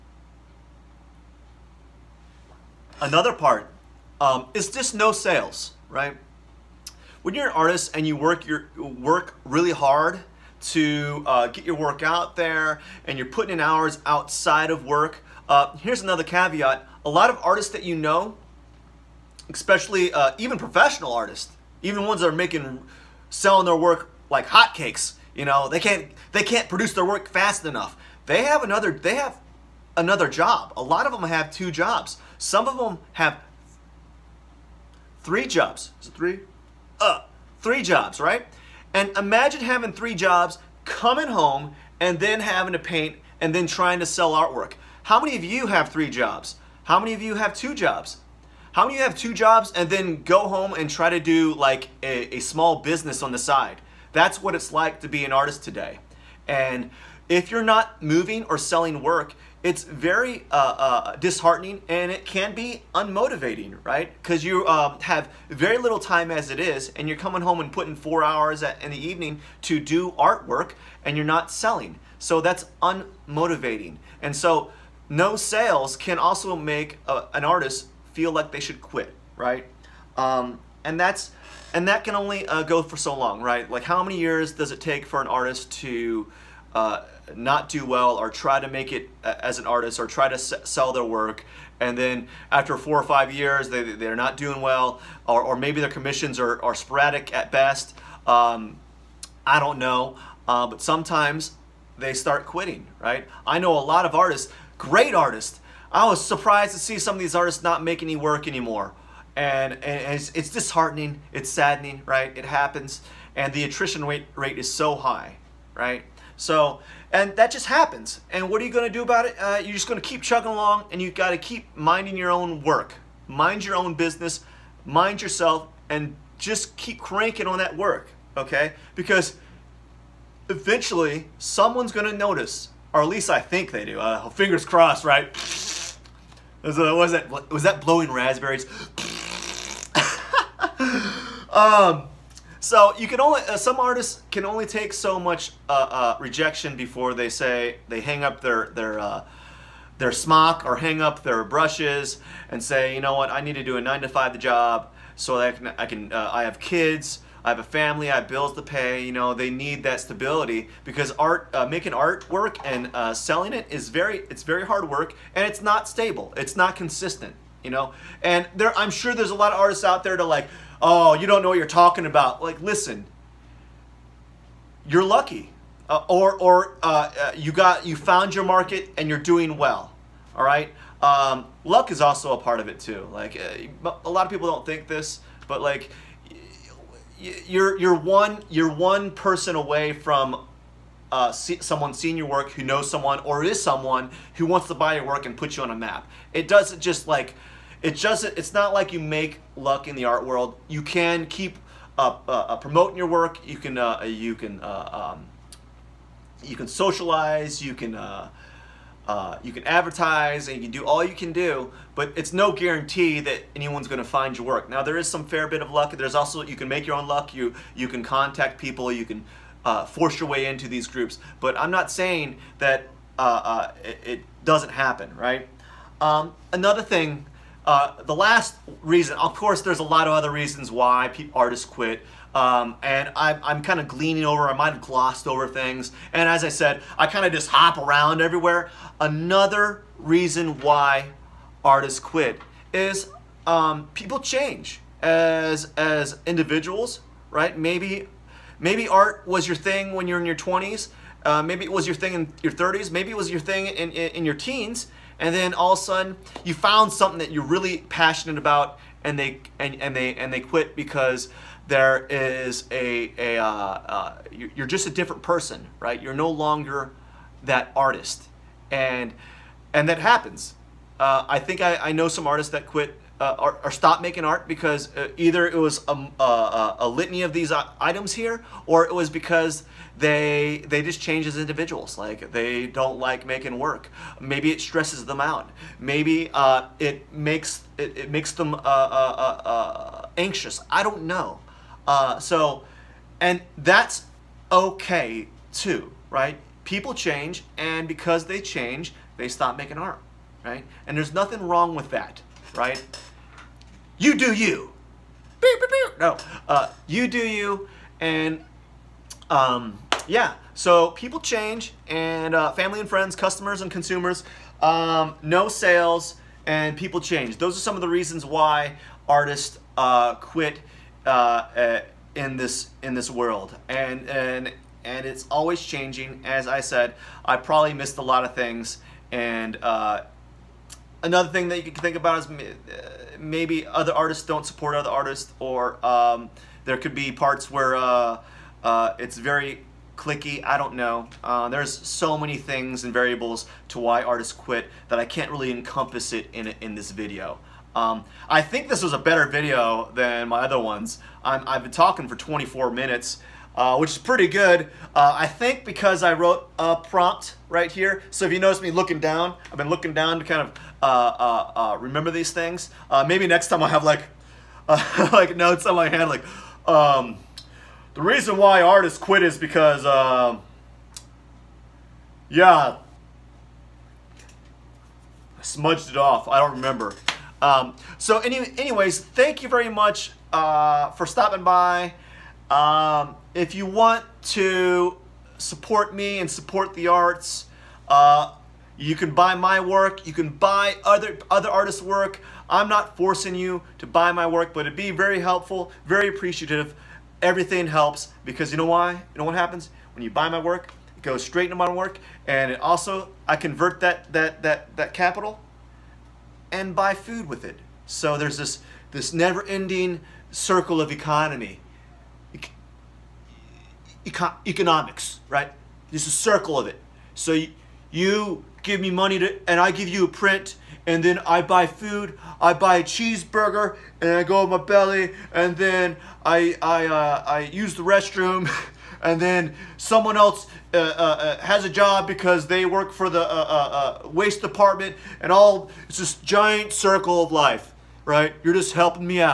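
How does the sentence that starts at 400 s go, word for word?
It goes straight into my work, and it also I convert that that that that capital and buy food with it.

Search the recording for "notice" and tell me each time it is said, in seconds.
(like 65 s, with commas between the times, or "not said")
132 s, 358 s.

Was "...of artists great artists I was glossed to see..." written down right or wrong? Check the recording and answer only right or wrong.
wrong.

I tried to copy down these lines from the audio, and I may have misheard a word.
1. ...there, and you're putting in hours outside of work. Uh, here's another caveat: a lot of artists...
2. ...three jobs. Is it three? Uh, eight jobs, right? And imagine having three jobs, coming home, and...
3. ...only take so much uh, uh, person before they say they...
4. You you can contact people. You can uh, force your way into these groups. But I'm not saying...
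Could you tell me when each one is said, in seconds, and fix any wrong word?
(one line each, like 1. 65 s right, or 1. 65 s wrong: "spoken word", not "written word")
1. 12 s right
2. 35 s wrong: "three", not "eight"
3. 144 s wrong: "rejection", not "person"
4. 217 s right.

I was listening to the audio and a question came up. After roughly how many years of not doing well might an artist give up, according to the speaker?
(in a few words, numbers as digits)
4 or 5.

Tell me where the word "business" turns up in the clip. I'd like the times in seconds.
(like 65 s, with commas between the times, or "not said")
52 s, 123 s.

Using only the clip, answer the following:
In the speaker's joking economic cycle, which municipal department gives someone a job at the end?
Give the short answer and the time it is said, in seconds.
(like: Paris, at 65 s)
waste department, at 434 s.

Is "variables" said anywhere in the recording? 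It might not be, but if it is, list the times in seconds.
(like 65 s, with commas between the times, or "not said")
342 s.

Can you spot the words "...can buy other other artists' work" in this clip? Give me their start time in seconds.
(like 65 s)
390 s.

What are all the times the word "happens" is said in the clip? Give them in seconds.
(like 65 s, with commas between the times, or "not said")
112 s, 117 s, 224 s, 269 s, 399 s.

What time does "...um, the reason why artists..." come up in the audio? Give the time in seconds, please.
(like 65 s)
366 s.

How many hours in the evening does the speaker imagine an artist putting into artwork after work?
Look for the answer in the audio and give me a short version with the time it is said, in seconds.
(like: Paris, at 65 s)
4, at 67 s.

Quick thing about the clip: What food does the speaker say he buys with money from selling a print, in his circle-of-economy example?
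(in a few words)
cheeseburger.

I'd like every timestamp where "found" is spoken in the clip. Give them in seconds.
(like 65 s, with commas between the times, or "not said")
177 s, 256 s.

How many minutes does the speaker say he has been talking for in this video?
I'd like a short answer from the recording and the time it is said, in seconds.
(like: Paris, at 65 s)
24, at 352 s.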